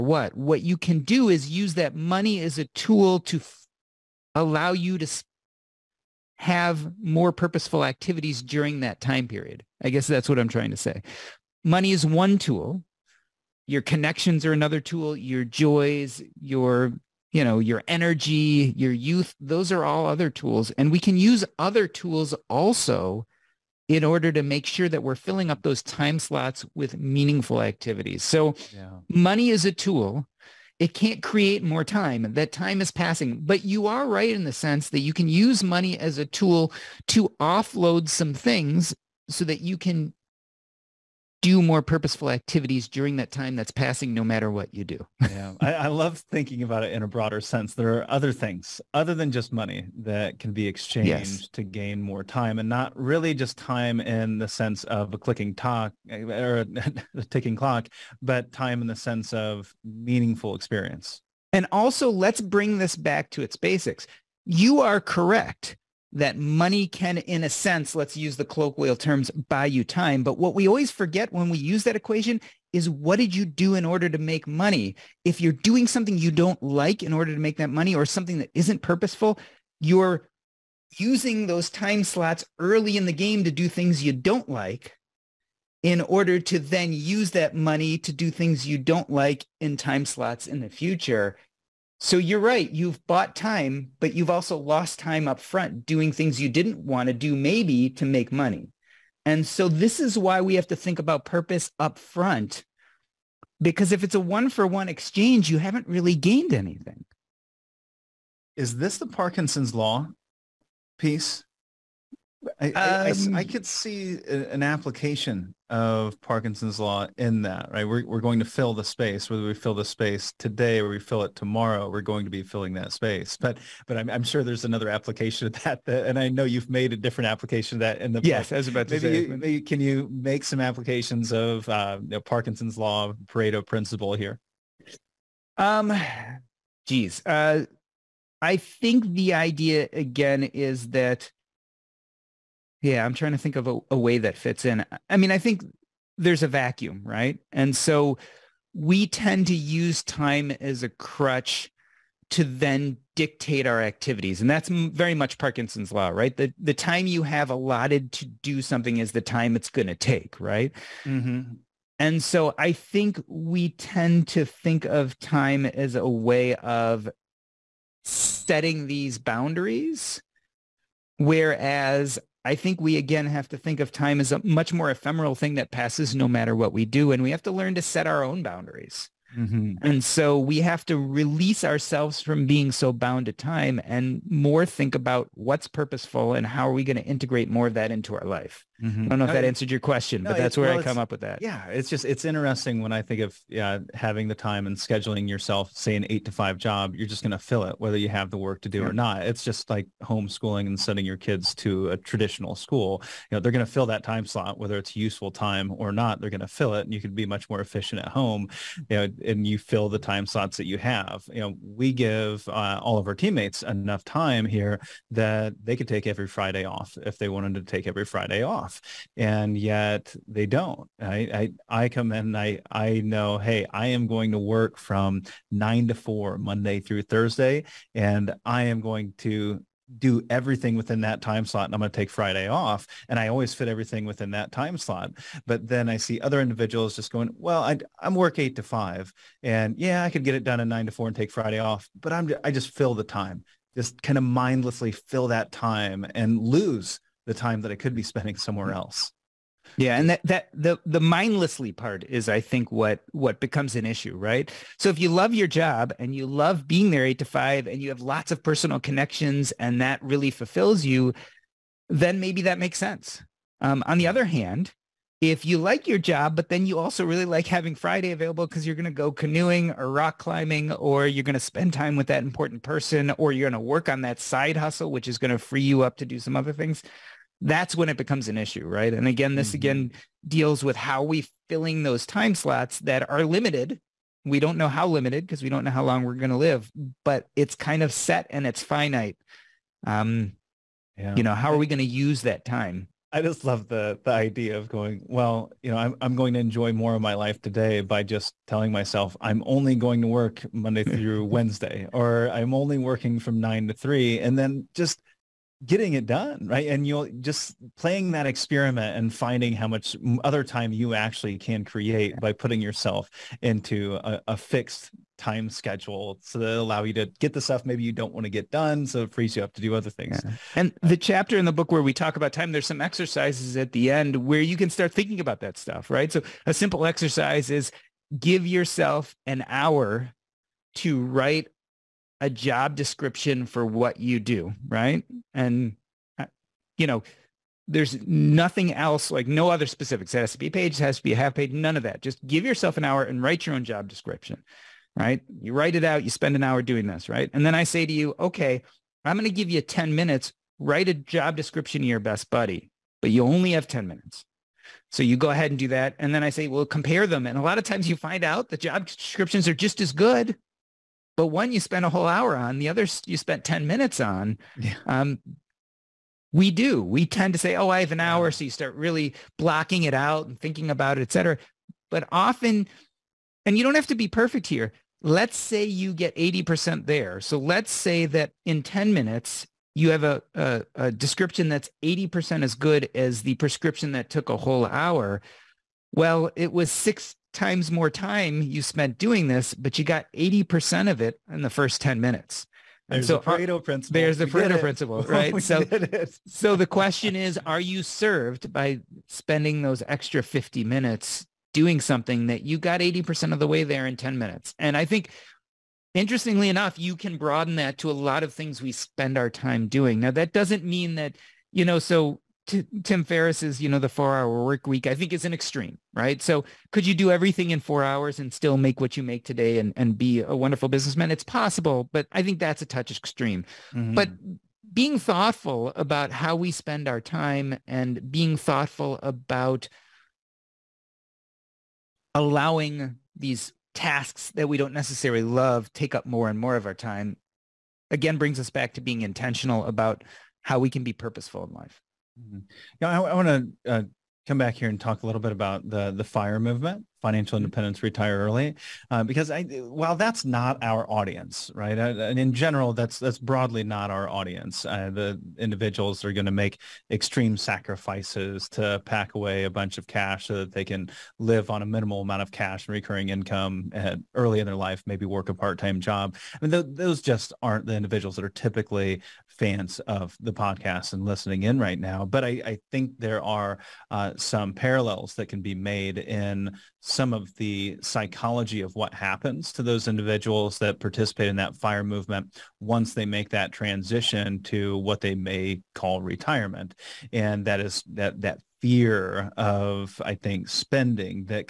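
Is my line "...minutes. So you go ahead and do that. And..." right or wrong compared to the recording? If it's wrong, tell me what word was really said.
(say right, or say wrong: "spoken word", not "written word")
right.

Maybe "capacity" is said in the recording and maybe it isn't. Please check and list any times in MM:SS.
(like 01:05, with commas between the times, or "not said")
not said.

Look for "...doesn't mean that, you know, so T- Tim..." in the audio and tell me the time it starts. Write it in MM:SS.
06:50.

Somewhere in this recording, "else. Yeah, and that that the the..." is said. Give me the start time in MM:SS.
04:08.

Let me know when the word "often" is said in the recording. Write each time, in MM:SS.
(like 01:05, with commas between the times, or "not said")
06:12.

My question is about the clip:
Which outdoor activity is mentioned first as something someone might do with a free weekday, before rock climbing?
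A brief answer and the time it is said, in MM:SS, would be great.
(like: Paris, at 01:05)
Canoeing, at 04:29.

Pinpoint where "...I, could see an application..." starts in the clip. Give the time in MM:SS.
01:53.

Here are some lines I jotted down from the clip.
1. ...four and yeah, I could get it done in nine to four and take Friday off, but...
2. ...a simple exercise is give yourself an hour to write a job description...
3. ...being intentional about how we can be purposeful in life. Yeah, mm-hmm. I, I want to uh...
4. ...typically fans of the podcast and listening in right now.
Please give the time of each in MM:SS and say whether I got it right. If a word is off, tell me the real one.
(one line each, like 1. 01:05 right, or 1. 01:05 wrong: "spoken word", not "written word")
1. 03:58 wrong: "five", not "four"
2. 05:26 right
3. 07:18 right
4. 07:48 right.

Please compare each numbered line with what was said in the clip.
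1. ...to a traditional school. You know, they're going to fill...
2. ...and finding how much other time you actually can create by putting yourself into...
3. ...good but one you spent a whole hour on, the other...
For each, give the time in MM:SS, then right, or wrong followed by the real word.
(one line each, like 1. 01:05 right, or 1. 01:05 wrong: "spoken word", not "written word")
1. 03:21 right
2. 05:08 right
3. 05:59 right.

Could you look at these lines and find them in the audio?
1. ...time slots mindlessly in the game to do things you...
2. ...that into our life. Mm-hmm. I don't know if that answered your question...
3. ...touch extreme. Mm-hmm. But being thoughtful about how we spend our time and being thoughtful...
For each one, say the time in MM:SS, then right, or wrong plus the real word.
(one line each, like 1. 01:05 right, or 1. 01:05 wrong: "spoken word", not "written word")
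1. 01:21 wrong: "early", not "mindlessly"
2. 03:07 right
3. 07:02 right.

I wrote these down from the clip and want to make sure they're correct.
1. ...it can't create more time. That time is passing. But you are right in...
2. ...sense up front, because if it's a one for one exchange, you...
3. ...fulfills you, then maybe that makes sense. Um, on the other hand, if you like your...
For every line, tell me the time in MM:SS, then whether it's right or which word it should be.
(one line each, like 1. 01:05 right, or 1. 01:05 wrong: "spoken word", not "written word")
1. 00:30 right
2. 01:41 wrong: "purpose", not "sense"
3. 04:20 right.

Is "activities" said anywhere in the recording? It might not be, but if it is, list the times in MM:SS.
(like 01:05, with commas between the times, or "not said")
00:07, 00:27, 00:42, 02:33.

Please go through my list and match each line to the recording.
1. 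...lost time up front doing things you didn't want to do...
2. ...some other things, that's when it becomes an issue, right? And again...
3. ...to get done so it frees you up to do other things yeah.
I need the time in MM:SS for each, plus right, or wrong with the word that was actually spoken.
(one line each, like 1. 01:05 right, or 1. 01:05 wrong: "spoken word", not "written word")
1. 01:34 right
2. 04:36 right
3. 05:18 right.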